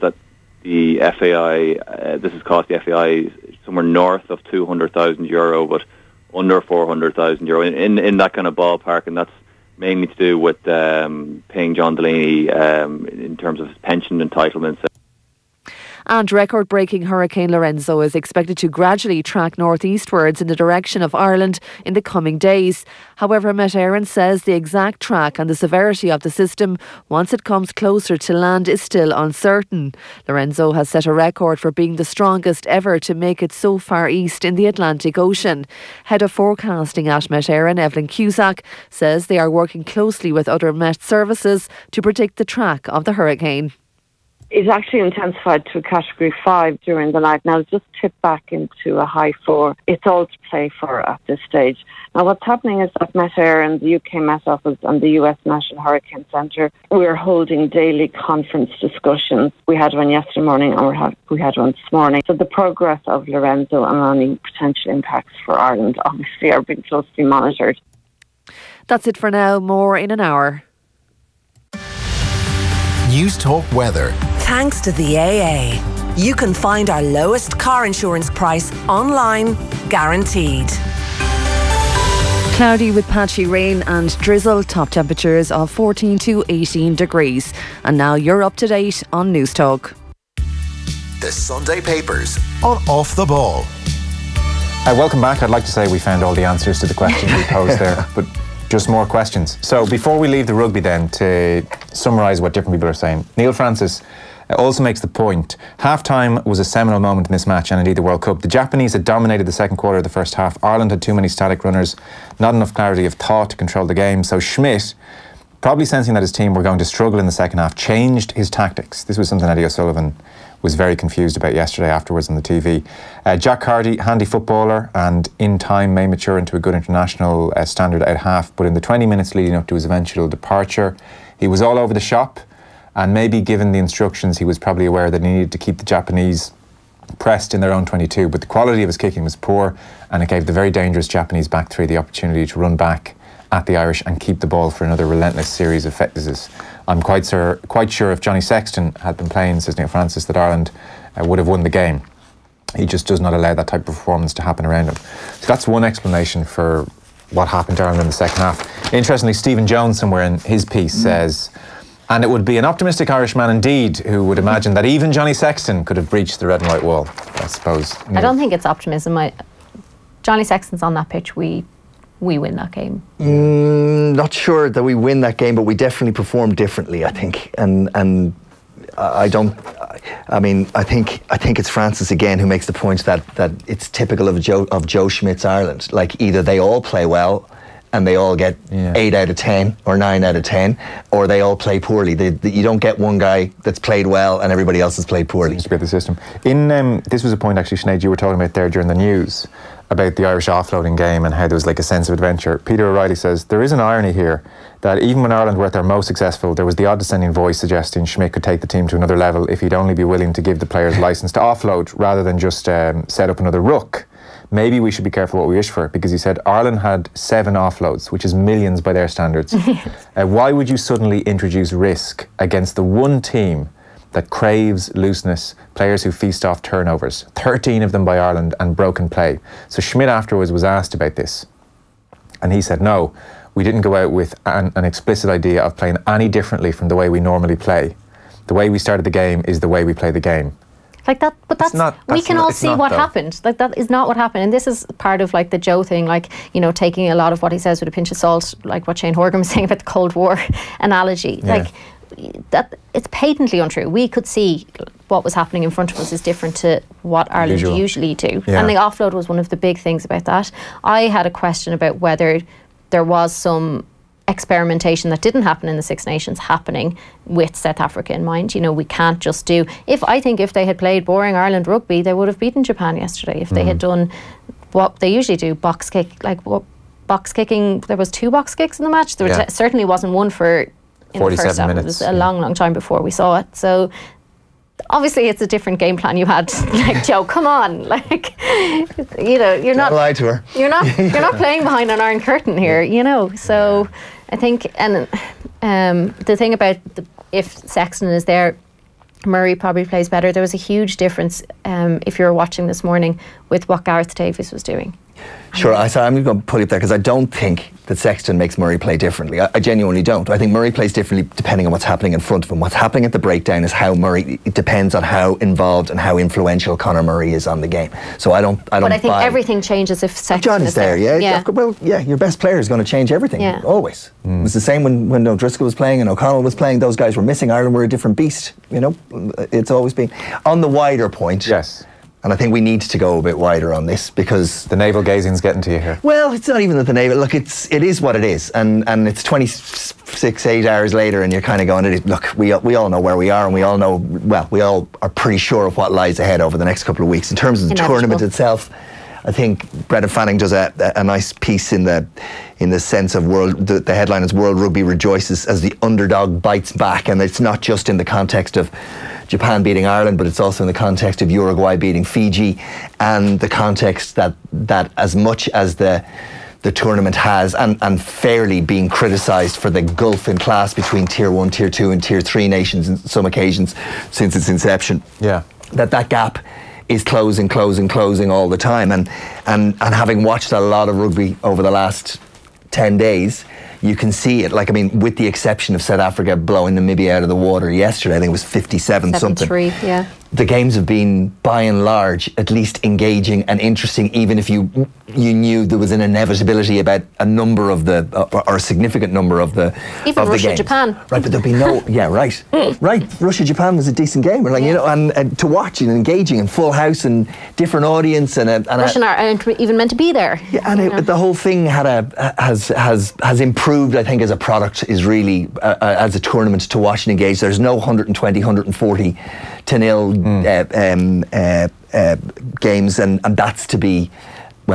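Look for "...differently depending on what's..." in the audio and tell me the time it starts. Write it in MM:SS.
05:10.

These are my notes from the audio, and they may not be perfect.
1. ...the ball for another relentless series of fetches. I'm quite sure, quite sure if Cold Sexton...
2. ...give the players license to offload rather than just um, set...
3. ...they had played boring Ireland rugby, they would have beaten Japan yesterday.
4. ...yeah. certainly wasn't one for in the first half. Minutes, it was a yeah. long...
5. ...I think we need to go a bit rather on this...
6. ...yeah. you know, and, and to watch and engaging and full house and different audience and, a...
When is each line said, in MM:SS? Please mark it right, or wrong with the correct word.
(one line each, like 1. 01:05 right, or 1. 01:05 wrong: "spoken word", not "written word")
1. 02:24 wrong: "Johnny", not "Cold"
2. 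03:30 right
3. 04:30 right
4. 04:39 right
5. 05:32 wrong: "wider", not "rather"
6. 06:44 right.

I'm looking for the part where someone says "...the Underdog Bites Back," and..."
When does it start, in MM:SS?
05:55.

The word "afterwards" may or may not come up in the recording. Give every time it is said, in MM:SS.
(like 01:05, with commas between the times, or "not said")
02:01, 03:50.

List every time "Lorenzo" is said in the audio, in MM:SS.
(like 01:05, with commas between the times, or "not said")
00:17, 00:30, 01:03.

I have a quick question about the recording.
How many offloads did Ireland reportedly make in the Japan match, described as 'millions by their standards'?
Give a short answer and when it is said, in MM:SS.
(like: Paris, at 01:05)
7, at 03:37.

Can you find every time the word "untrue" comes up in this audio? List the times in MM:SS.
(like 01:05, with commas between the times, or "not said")
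04:13.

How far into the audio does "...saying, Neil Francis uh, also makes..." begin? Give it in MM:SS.
01:43.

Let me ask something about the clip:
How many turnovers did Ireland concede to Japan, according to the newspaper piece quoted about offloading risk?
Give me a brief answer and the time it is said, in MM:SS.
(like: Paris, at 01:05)
13, at 03:47.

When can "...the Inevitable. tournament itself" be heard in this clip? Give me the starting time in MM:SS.
05:47.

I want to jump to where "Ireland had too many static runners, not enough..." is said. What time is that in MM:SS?
01:50.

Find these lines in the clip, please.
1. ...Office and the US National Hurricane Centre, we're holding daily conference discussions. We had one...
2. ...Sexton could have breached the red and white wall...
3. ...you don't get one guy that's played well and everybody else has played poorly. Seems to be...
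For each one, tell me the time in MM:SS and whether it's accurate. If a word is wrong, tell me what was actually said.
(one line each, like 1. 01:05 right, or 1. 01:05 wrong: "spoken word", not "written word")
1. 00:54 right
2. 02:45 right
3. 03:12 right.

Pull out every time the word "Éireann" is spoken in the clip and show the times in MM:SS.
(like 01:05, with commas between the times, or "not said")
00:23, 00:37, 00:53.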